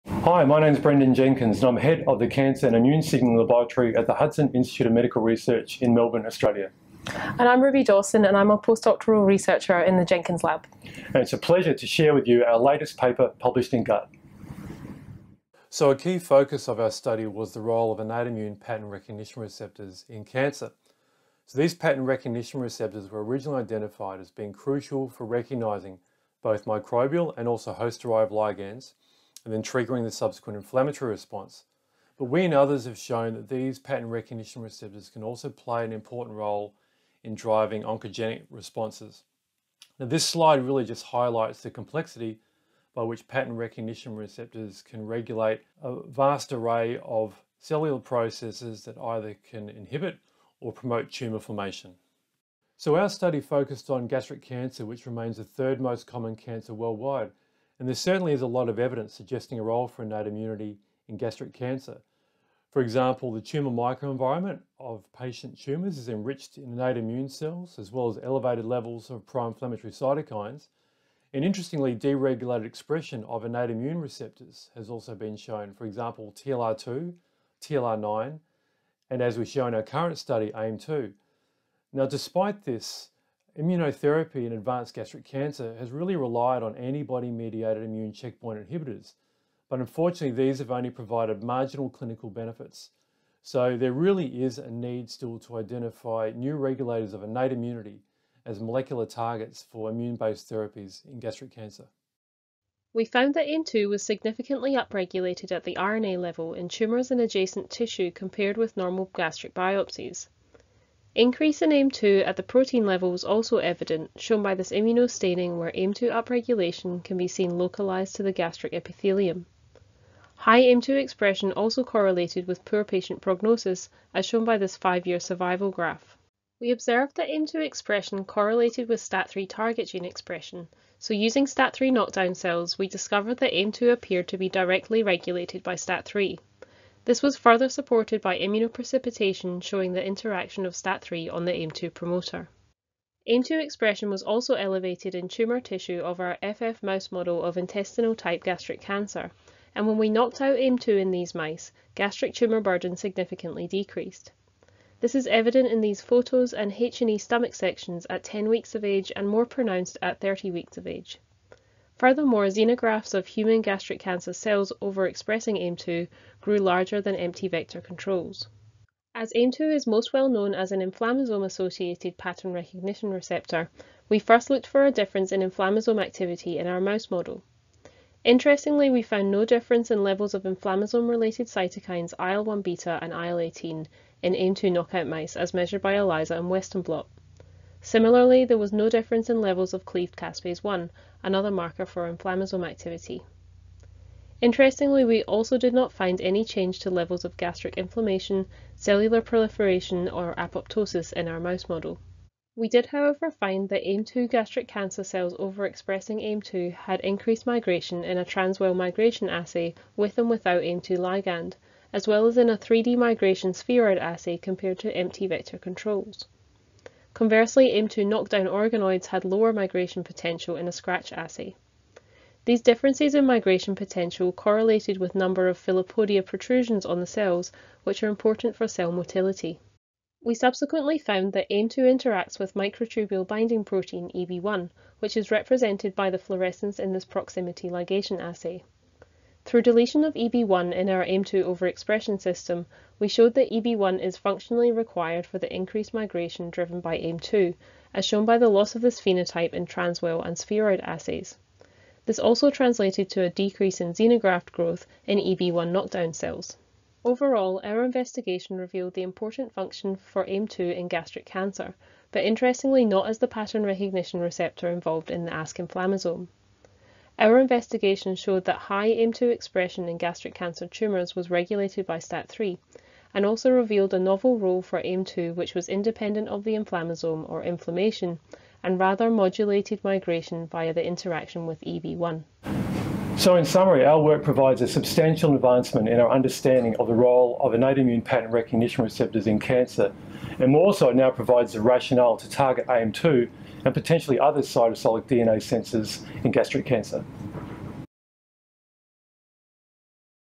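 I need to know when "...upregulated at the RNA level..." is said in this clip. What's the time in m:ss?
1:44.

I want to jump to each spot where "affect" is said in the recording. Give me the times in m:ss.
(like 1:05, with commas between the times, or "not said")
not said.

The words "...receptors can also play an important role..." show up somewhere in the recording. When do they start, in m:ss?
0:34.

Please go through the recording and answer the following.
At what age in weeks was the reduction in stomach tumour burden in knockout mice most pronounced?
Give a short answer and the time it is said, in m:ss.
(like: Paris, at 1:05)
30 weeks, at 2:40.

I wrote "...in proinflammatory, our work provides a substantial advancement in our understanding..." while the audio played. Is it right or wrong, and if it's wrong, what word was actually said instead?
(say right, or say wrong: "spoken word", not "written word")
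wrong: "summary", not "proinflammatory".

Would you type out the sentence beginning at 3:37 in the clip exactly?
Conversely, m 2 knockdown organoids had lower migration potential in a scratch assay.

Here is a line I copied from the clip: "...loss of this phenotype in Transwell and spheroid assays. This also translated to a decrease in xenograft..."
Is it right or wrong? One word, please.
right.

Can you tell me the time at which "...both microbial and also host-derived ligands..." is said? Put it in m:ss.
0:26.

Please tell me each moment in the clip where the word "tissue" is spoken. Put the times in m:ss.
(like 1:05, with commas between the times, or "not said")
1:47, 2:25.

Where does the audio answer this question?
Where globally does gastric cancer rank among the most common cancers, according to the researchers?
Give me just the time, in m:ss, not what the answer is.
0:55.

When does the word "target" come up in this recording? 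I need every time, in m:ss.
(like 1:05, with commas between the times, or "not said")
1:39, 2:09, 4:52.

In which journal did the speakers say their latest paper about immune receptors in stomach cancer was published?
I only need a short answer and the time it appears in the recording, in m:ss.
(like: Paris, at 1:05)
GUT, at 0:13.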